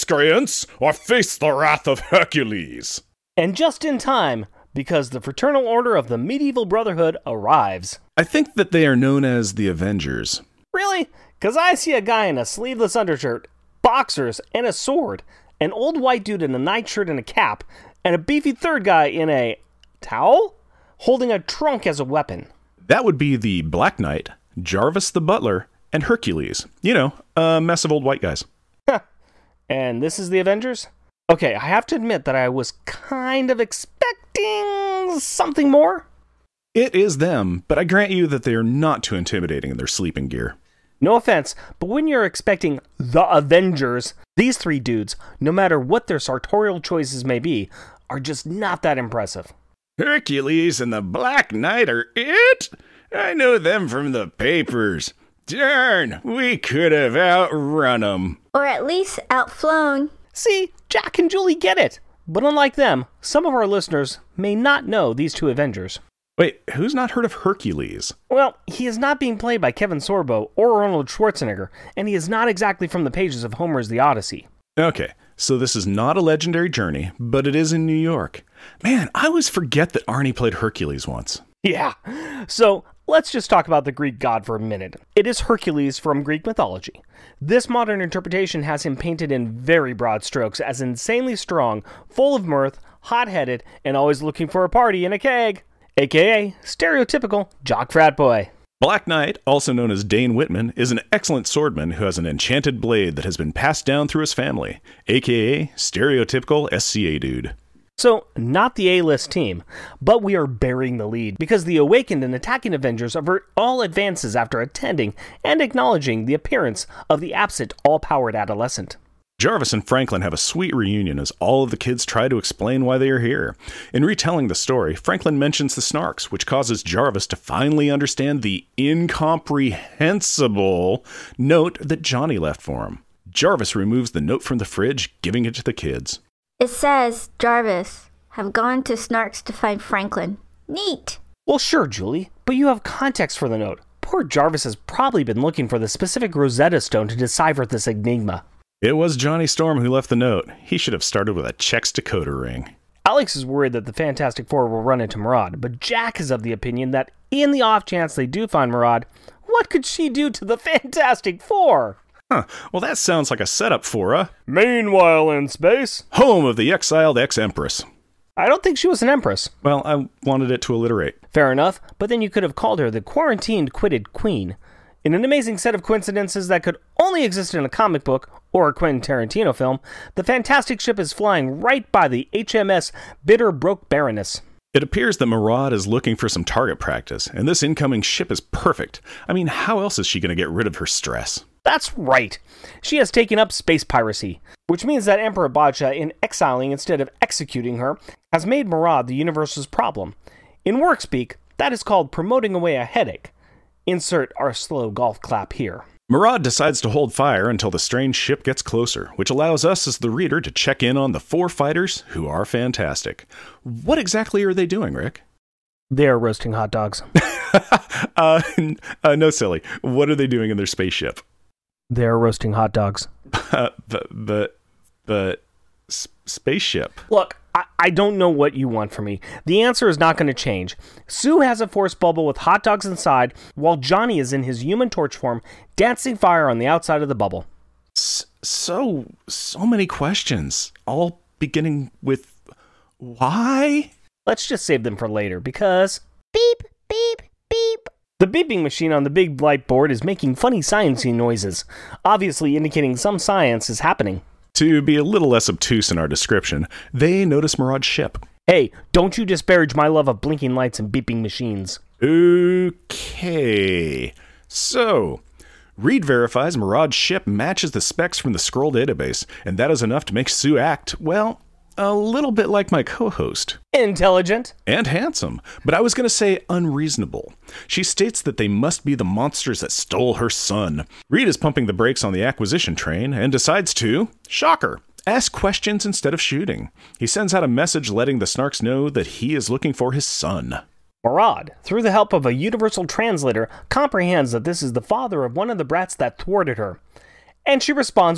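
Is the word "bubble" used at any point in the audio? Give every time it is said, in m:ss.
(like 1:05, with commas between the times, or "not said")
3:51, 3:57.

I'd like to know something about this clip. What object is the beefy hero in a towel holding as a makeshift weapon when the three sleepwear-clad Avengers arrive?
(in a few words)
A trunk.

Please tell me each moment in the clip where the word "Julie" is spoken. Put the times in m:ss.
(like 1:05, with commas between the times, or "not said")
1:01, 2:21.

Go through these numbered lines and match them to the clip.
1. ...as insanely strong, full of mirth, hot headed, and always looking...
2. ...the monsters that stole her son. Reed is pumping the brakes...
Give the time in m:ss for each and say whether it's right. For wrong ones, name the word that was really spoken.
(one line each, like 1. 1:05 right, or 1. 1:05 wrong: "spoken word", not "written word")
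1. 1:30 right
2. 4:38 right.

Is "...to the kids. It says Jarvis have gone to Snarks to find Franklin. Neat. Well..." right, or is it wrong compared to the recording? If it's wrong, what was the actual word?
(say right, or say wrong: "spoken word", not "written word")
right.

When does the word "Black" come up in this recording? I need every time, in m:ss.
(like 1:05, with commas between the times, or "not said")
0:23, 0:51, 1:38.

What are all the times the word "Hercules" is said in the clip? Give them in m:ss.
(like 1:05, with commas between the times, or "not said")
0:01, 0:26, 0:49, 1:07, 1:20, 1:25.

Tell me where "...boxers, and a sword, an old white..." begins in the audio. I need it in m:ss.
0:13.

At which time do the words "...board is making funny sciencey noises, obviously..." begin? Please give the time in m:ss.
4:09.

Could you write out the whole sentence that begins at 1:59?
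Jarvis and Franklin have a sweet reunion as all of the kids try to explain why they are here.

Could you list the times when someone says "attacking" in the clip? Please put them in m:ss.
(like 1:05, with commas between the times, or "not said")
1:52.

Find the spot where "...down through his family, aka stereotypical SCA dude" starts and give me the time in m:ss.
1:43.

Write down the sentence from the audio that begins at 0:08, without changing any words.
I think that they are known as the Avengers.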